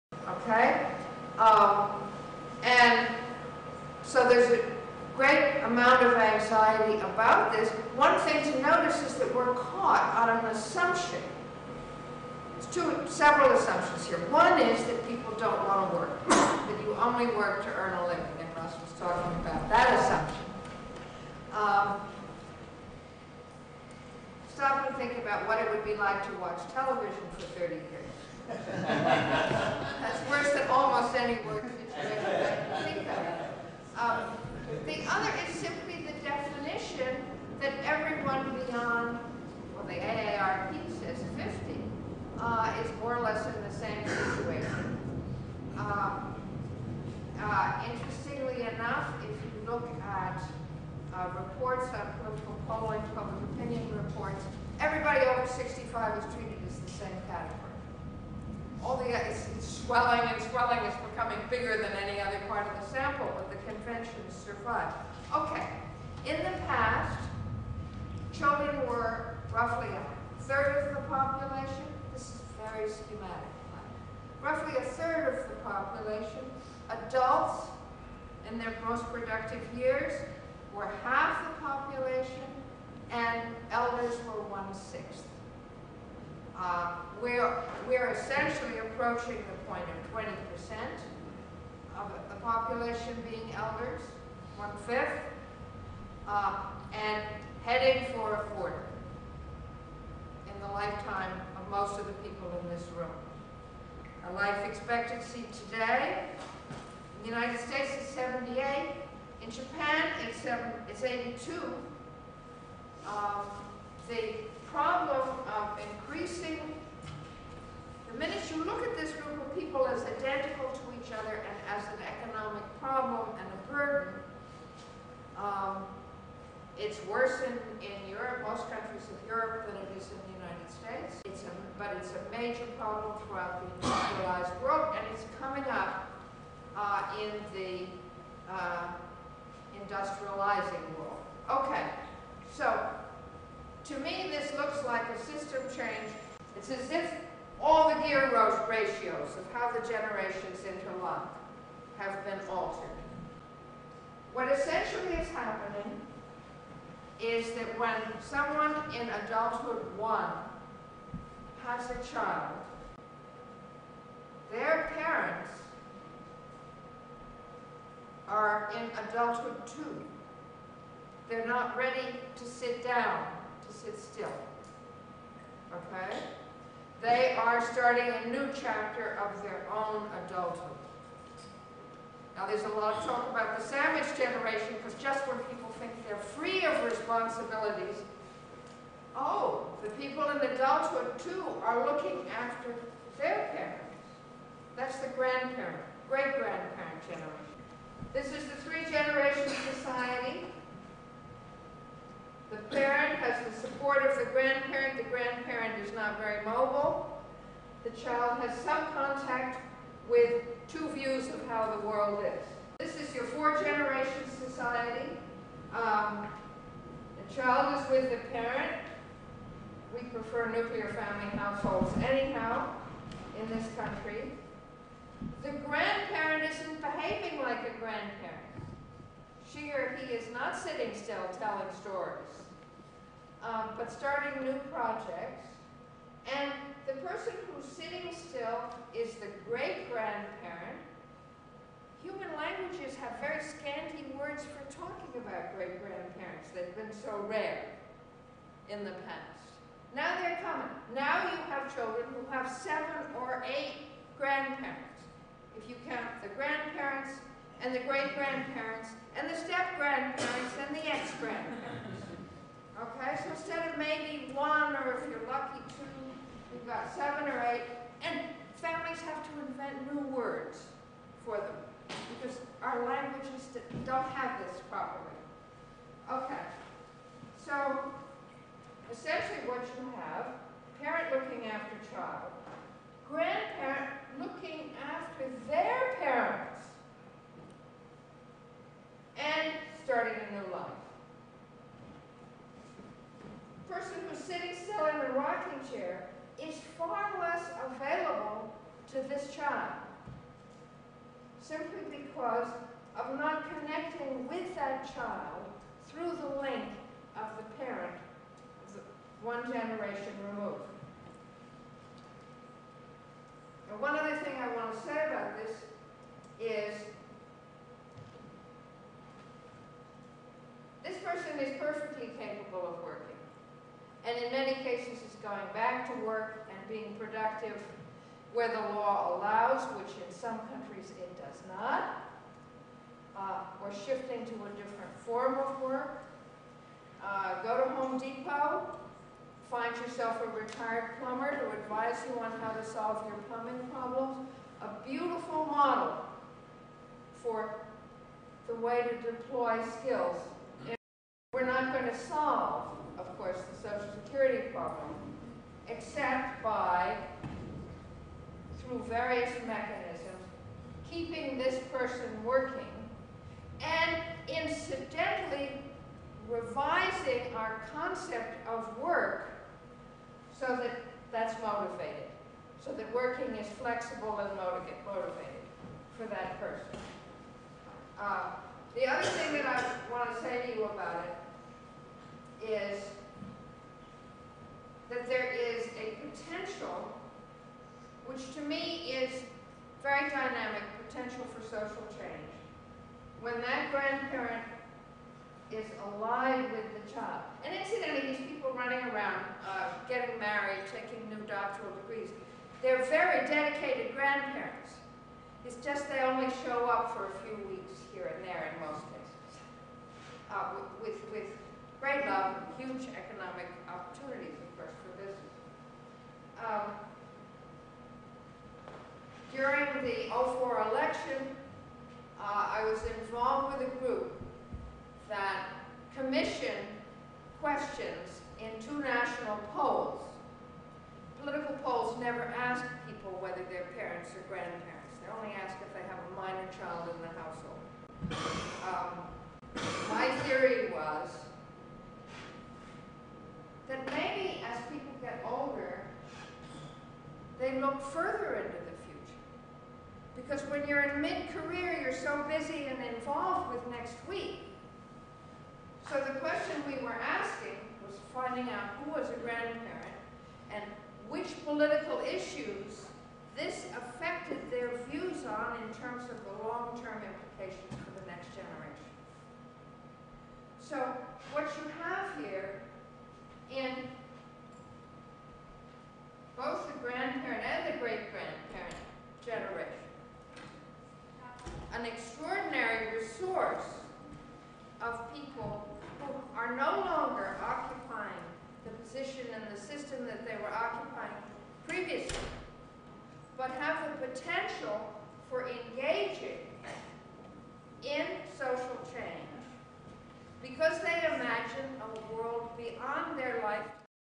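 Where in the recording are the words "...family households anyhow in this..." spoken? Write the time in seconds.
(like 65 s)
220 s.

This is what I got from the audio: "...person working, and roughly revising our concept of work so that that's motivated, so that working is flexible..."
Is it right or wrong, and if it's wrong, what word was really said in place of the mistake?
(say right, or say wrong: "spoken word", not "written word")
wrong: "incidentally", not "roughly".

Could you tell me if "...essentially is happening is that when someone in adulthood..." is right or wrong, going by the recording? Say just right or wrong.
right.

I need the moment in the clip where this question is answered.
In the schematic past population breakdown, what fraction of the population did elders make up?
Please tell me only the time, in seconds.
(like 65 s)
84 s.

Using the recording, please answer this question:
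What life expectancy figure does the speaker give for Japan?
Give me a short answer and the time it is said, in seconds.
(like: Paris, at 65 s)
82, at 111 s.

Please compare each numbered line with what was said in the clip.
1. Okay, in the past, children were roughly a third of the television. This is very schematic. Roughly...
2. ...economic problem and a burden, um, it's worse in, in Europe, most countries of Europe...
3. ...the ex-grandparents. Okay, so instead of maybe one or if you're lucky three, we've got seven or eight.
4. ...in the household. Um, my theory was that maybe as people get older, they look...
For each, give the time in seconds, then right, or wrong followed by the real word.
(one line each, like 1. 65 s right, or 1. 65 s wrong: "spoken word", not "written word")
1. 65 s wrong: "population", not "television"
2. 122 s right
3. 260 s wrong: "two", not "three"
4. 436 s right.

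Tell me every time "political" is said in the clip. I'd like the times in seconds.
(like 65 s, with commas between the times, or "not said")
52 s, 431 s, 461 s.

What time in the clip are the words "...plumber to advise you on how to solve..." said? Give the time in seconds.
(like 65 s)
341 s.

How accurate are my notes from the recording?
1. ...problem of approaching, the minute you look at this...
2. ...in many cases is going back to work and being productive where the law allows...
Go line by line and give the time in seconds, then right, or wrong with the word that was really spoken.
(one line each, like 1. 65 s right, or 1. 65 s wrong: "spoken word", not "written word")
1. 114 s wrong: "increasing", not "approaching"
2. 324 s right.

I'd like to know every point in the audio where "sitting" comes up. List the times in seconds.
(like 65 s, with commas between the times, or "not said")
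230 s, 237 s.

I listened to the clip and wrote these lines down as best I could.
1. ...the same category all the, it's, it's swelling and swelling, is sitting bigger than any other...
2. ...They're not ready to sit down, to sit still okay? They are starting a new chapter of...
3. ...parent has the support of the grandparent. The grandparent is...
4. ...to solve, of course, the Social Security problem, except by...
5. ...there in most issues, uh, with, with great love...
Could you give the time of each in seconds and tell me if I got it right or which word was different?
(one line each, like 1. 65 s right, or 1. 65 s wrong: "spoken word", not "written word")
1. 56 s wrong: "becoming", not "sitting"
2. 171 s right
3. 202 s right
4. 351 s right
5. 408 s wrong: "cases", not "issues".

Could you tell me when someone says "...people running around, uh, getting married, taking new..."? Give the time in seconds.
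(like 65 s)
398 s.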